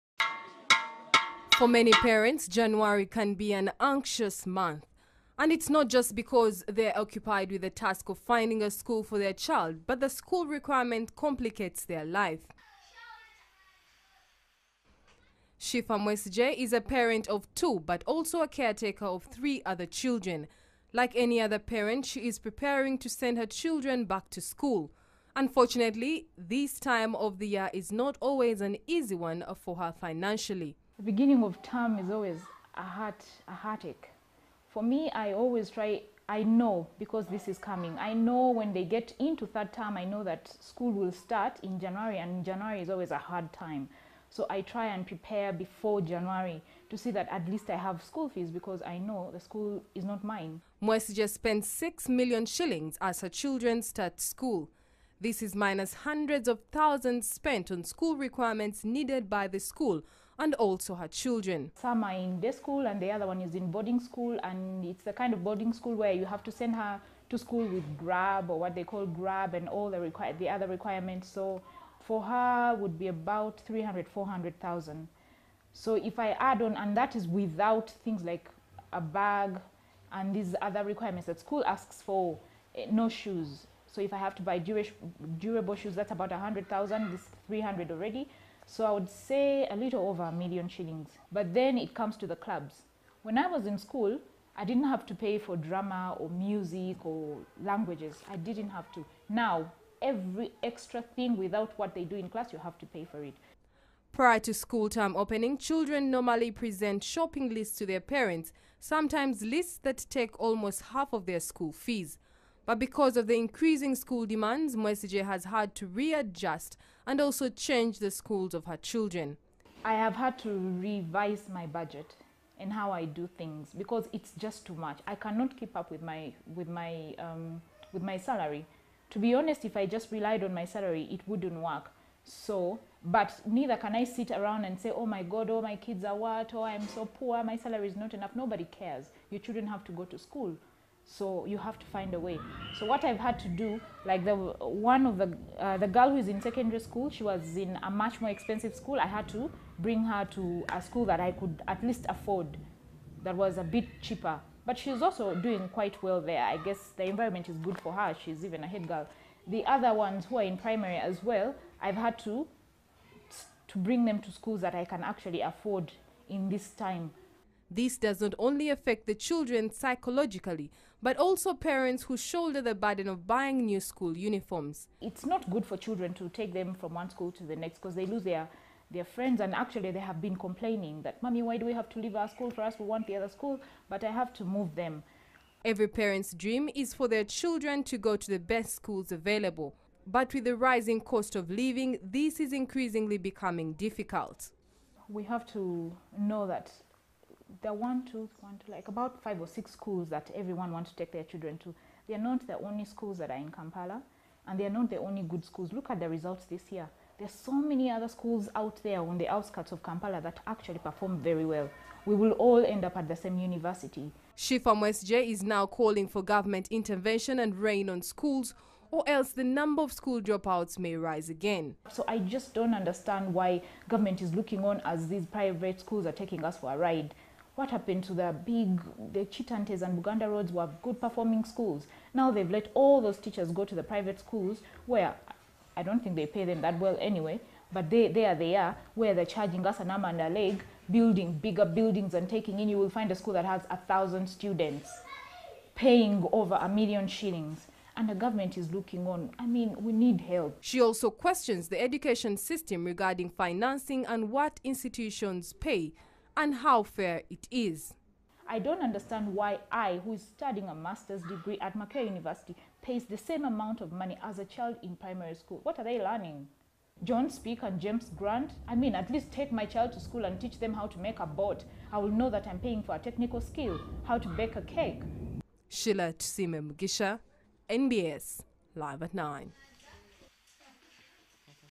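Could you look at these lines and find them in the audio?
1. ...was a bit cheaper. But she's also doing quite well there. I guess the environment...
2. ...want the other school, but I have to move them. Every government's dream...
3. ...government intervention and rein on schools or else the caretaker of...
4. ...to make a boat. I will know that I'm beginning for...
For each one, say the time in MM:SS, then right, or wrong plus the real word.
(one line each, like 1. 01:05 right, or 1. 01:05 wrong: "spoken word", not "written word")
1. 02:33 right
2. 03:02 wrong: "parent", not "government"
3. 03:36 wrong: "number", not "caretaker"
4. 04:30 wrong: "paying", not "beginning".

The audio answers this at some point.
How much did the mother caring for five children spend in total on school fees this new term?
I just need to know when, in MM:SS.
00:51.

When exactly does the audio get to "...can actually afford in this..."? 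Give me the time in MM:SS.
02:44.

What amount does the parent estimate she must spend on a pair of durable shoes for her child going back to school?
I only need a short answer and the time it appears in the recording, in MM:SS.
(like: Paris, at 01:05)
100,000, at 01:26.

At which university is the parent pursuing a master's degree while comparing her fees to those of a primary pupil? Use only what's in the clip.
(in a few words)
Makerere University.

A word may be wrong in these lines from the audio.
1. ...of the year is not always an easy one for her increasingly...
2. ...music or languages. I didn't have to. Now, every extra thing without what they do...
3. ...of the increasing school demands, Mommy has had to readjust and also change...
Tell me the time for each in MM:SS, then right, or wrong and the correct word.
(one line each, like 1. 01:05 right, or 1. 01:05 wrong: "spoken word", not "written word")
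1. 00:27 wrong: "financially", not "increasingly"
2. 01:36 right
3. 01:53 wrong: "Mwesigye", not "Mommy".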